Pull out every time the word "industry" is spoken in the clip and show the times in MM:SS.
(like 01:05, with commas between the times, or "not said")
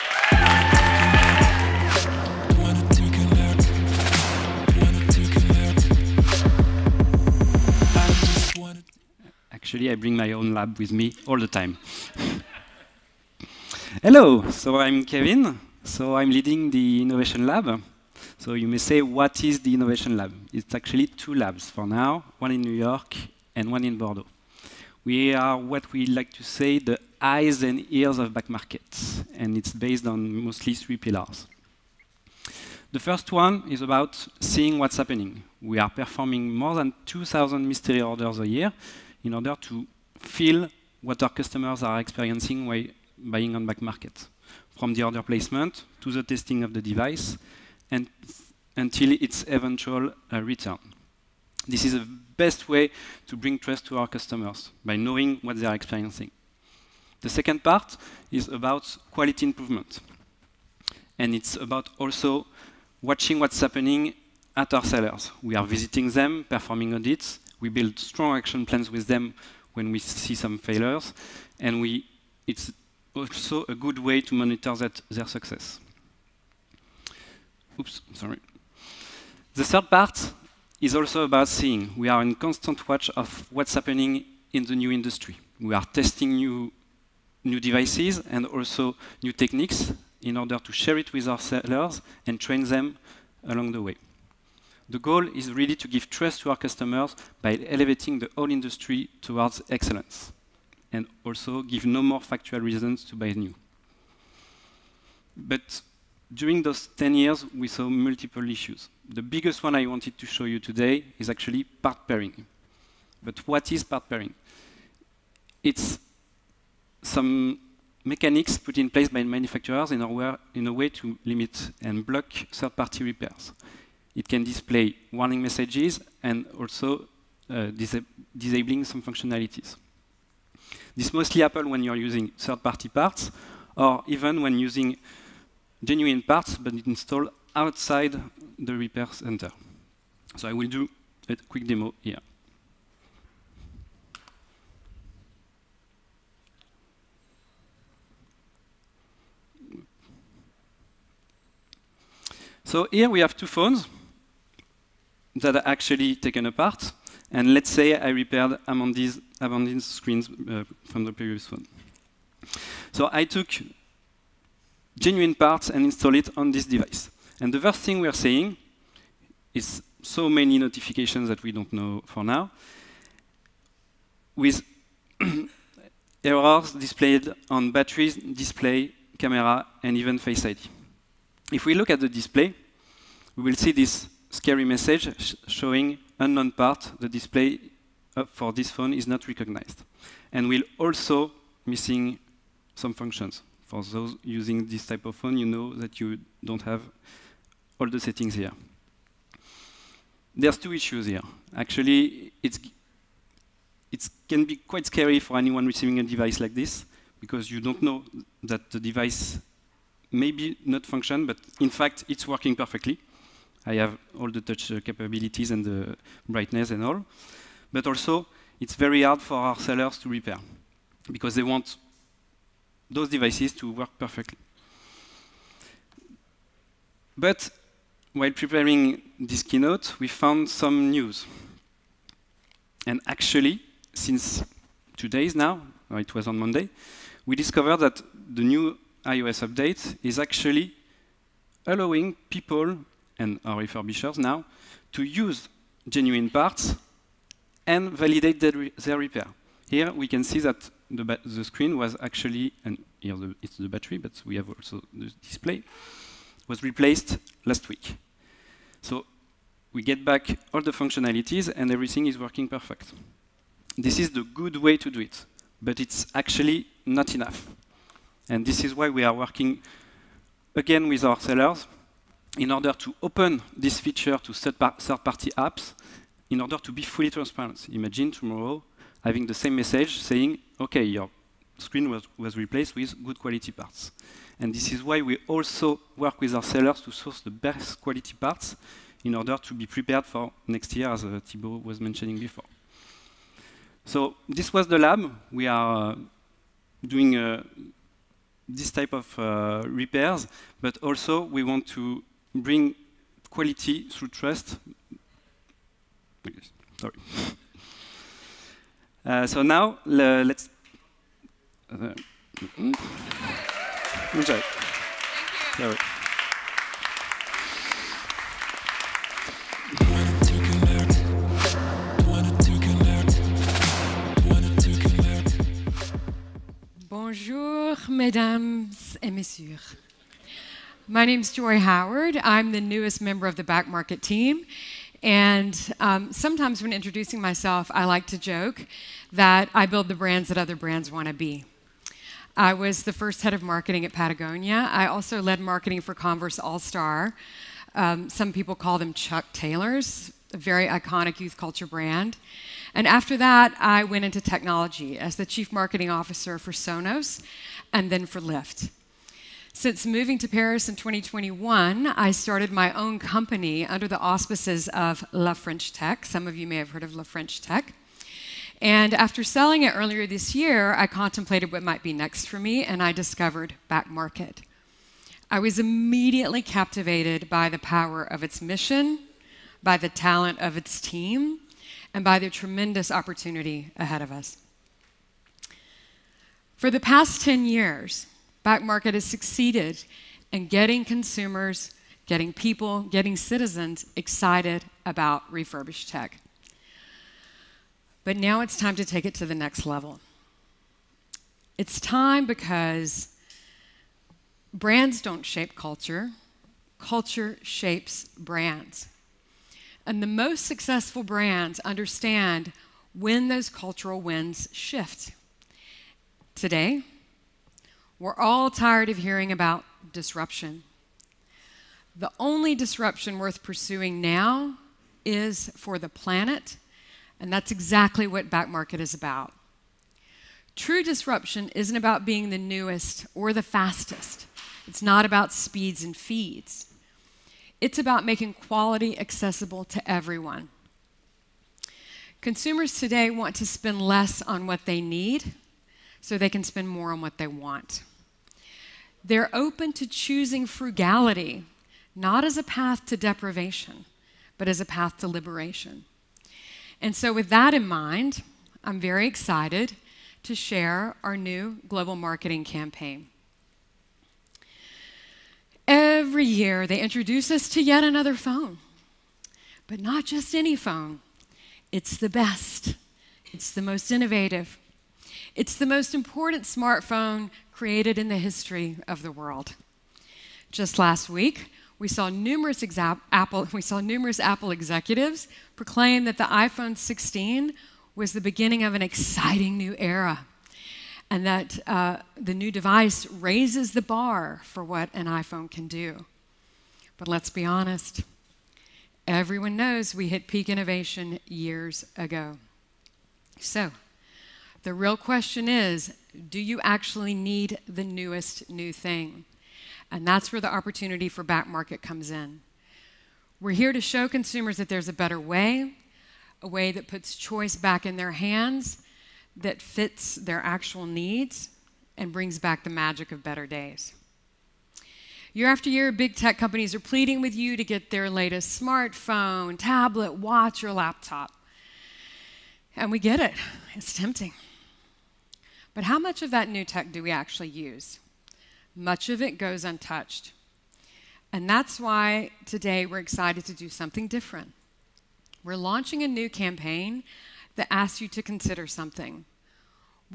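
01:24, 01:38.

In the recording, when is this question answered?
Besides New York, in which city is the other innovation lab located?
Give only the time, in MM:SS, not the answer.
00:23.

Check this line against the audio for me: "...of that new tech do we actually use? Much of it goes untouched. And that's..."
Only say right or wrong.
right.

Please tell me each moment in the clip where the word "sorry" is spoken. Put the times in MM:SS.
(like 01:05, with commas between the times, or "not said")
01:18, 05:06.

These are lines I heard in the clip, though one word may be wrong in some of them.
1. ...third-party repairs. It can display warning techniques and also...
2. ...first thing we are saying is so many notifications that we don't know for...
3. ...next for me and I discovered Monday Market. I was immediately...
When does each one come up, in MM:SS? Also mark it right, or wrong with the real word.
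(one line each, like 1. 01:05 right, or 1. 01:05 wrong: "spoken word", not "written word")
1. 02:02 wrong: "messages", not "techniques"
2. 02:47 right
3. 06:11 wrong: "Back", not "Monday".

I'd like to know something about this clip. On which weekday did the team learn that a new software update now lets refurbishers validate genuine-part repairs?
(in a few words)
Monday.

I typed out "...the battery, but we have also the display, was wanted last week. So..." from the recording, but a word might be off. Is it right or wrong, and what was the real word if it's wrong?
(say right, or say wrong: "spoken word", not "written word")
wrong: "replaced", not "wanted".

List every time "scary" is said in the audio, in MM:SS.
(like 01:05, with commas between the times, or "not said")
03:04, 03:24.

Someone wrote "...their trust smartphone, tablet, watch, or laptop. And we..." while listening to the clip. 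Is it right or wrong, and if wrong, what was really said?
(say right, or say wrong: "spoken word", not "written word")
wrong: "latest", not "trust".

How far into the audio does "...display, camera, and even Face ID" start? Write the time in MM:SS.
02:58.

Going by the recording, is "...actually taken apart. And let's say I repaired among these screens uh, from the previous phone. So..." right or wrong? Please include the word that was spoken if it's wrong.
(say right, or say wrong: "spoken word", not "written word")
right.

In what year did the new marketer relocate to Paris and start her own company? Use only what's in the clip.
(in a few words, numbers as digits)
2021.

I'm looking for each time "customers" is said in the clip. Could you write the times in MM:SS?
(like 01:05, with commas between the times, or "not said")
00:41, 00:54, 01:36.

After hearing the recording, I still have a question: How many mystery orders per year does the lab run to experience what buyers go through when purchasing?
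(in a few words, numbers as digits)
more than 2,000.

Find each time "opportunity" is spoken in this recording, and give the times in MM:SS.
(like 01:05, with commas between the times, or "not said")
06:22, 08:30.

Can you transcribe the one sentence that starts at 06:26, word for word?
For the past 10 years, back market has succeeded in getting consumers, getting people, getting citizens excited about refurbished tech.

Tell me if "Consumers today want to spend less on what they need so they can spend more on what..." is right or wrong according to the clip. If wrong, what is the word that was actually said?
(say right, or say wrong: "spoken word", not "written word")
right.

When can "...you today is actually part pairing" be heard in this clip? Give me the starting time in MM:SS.
01:50.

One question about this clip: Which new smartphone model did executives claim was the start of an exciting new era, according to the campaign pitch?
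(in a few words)
iPhone 16.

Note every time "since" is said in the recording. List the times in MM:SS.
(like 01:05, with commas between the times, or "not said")
03:53, 05:59.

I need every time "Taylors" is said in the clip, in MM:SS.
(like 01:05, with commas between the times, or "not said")
05:49.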